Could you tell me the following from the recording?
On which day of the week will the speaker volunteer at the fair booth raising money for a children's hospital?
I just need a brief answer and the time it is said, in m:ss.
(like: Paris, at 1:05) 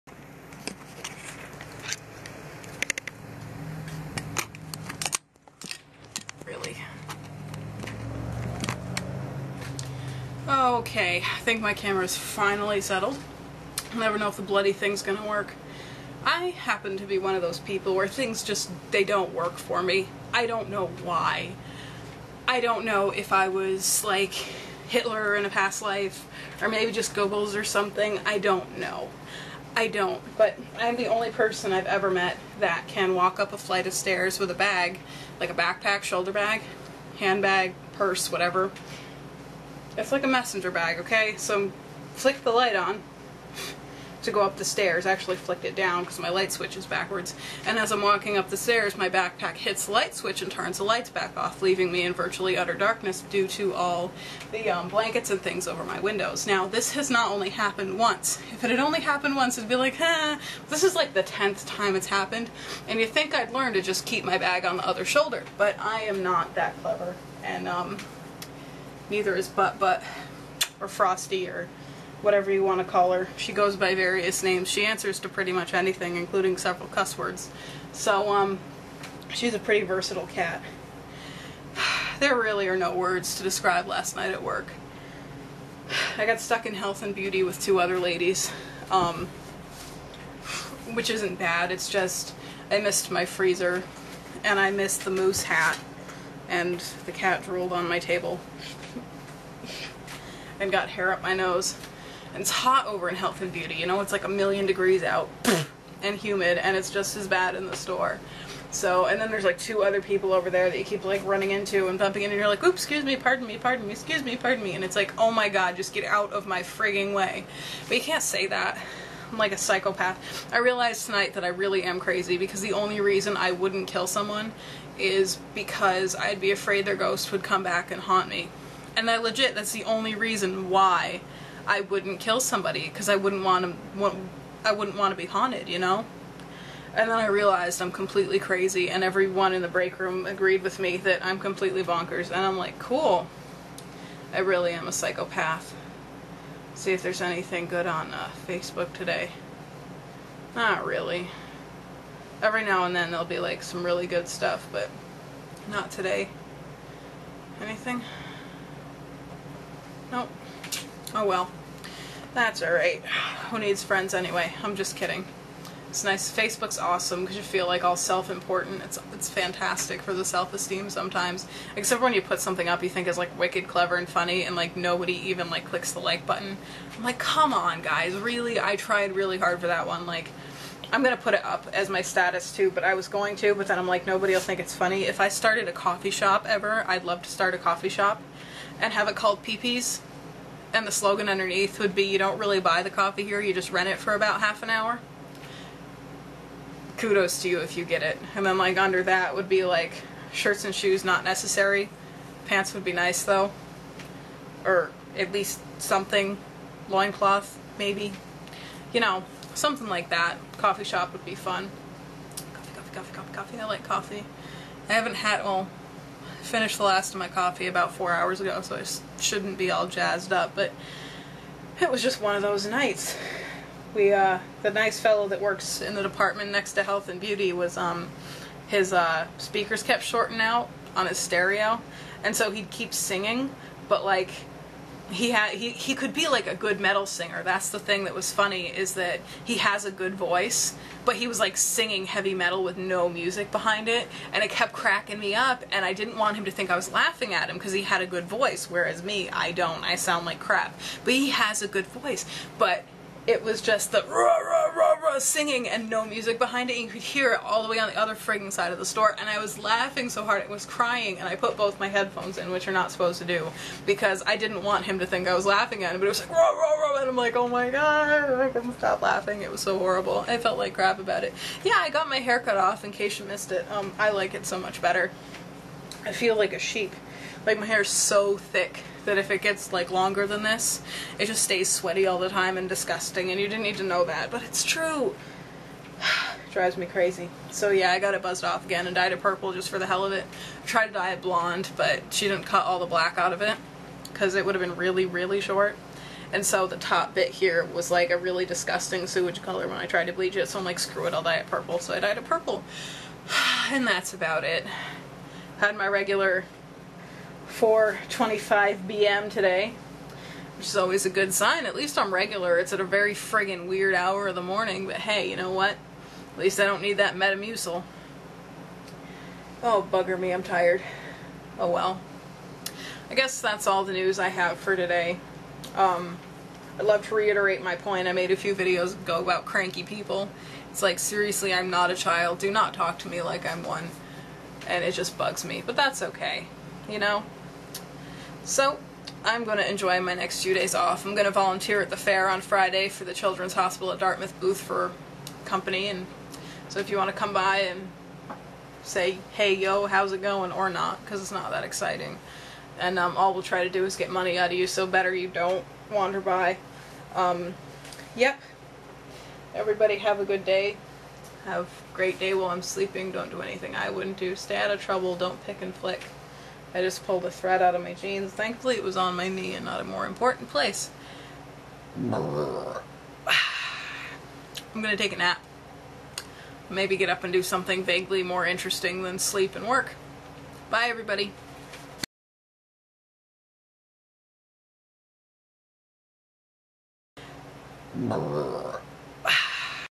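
Friday, at 5:42.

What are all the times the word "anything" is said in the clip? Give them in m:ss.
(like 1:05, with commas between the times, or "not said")
1:15, 2:27, 2:37, 6:03.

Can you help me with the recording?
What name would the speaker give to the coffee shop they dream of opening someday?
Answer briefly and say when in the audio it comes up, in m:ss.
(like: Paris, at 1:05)
Peepees, at 3:09.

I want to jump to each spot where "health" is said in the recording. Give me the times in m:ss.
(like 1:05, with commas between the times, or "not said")
1:26, 1:43, 3:46.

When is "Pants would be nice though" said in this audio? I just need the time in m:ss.
3:22.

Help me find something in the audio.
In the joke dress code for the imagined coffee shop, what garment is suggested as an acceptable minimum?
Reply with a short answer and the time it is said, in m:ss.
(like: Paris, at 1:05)
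Loincloth, at 3:26.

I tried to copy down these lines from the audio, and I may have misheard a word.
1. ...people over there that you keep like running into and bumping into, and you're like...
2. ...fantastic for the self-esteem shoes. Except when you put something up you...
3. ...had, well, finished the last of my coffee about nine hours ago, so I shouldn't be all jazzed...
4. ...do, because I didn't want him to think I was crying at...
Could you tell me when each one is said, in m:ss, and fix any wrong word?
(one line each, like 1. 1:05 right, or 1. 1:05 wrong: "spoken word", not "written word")
1. 1:50 right
2. 2:49 wrong: "sometimes", not "shoes"
3. 3:35 wrong: "four", not "nine"
4. 4:23 wrong: "laughing", not "crying".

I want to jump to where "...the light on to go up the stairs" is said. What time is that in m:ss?
0:42.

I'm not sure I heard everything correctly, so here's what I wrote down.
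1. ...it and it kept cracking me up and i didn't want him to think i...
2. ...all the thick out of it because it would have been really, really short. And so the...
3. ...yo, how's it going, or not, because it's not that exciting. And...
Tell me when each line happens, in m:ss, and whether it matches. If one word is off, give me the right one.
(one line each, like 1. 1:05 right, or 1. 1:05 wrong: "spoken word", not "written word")
1. 4:03 right
2. 4:52 wrong: "black", not "thick"
3. 5:49 right.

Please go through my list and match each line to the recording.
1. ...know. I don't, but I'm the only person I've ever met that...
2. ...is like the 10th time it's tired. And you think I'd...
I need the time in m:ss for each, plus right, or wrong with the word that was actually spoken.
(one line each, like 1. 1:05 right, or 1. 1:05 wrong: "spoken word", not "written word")
1. 0:28 right
2. 1:00 wrong: "happened", not "tired".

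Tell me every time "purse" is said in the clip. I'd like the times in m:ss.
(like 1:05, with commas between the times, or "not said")
0:37.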